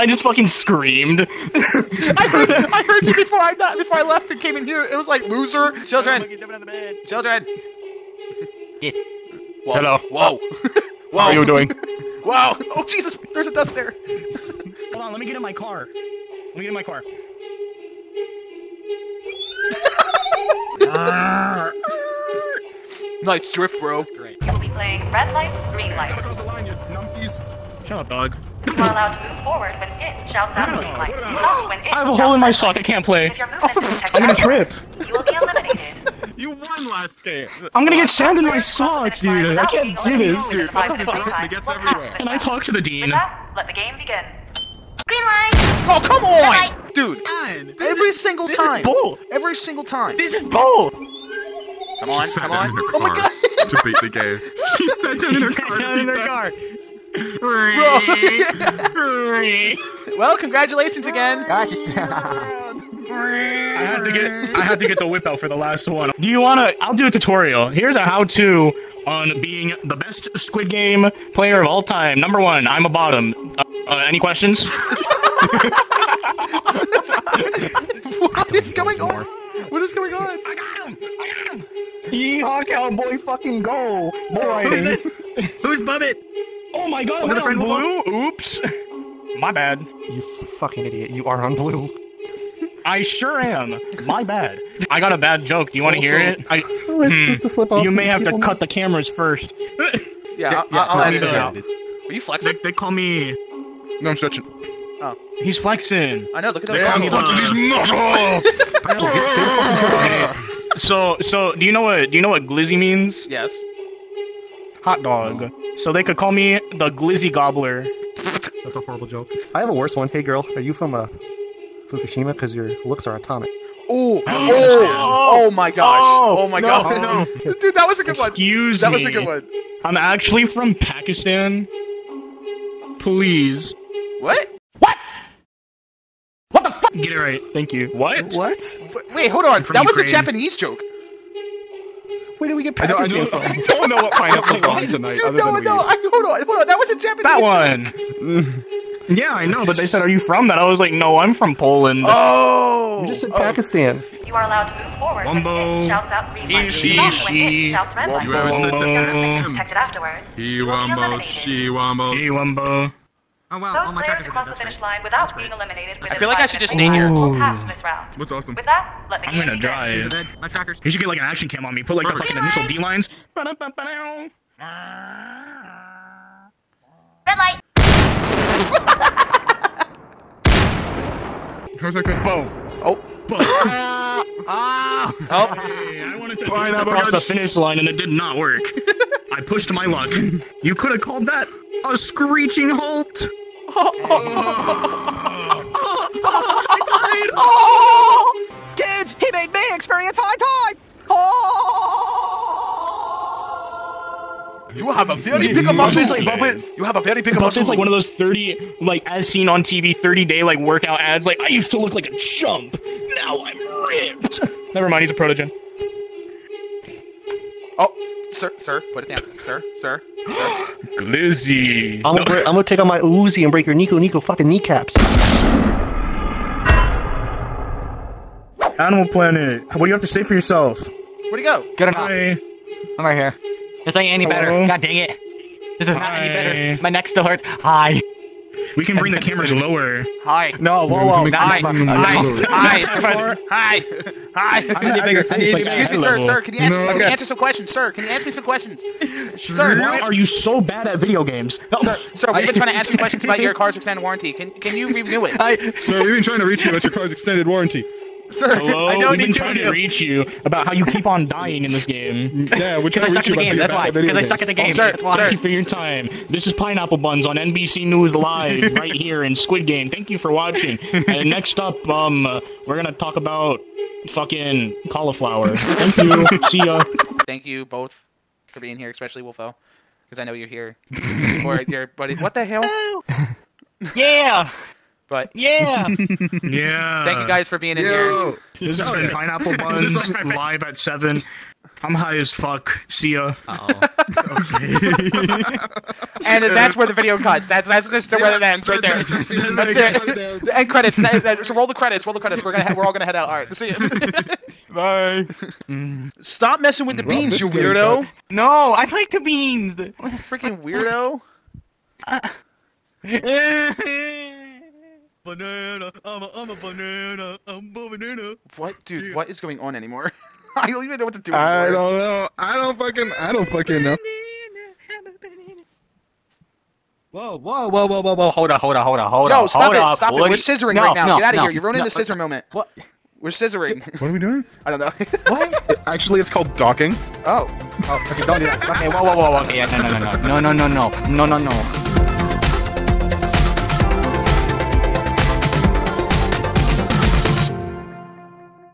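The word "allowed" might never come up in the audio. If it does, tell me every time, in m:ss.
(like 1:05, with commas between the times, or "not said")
0:28, 2:34.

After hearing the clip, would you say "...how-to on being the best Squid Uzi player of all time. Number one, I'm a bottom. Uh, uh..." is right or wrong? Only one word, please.
wrong.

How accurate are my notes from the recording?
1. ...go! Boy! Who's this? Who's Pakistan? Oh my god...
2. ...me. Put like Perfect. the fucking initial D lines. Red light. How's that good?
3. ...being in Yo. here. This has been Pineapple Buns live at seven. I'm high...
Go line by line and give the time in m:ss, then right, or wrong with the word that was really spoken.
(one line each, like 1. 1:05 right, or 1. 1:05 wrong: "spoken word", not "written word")
1. 1:23 wrong: "Buttbit", not "Pakistan"
2. 2:51 right
3. 4:47 right.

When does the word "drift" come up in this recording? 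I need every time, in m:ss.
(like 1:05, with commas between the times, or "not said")
0:23.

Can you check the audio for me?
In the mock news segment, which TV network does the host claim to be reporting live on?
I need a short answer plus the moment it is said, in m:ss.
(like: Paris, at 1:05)
NBC, at 4:27.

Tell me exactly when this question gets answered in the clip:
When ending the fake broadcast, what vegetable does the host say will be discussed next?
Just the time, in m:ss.
4:34.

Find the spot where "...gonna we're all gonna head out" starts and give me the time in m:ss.
5:02.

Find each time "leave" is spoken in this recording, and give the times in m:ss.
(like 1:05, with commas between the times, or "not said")
1:41.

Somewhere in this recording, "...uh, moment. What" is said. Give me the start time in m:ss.
5:32.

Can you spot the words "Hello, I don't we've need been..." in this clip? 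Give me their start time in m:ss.
4:18.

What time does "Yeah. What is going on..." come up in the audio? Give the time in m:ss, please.
5:19.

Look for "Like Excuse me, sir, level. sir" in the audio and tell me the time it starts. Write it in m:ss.
4:05.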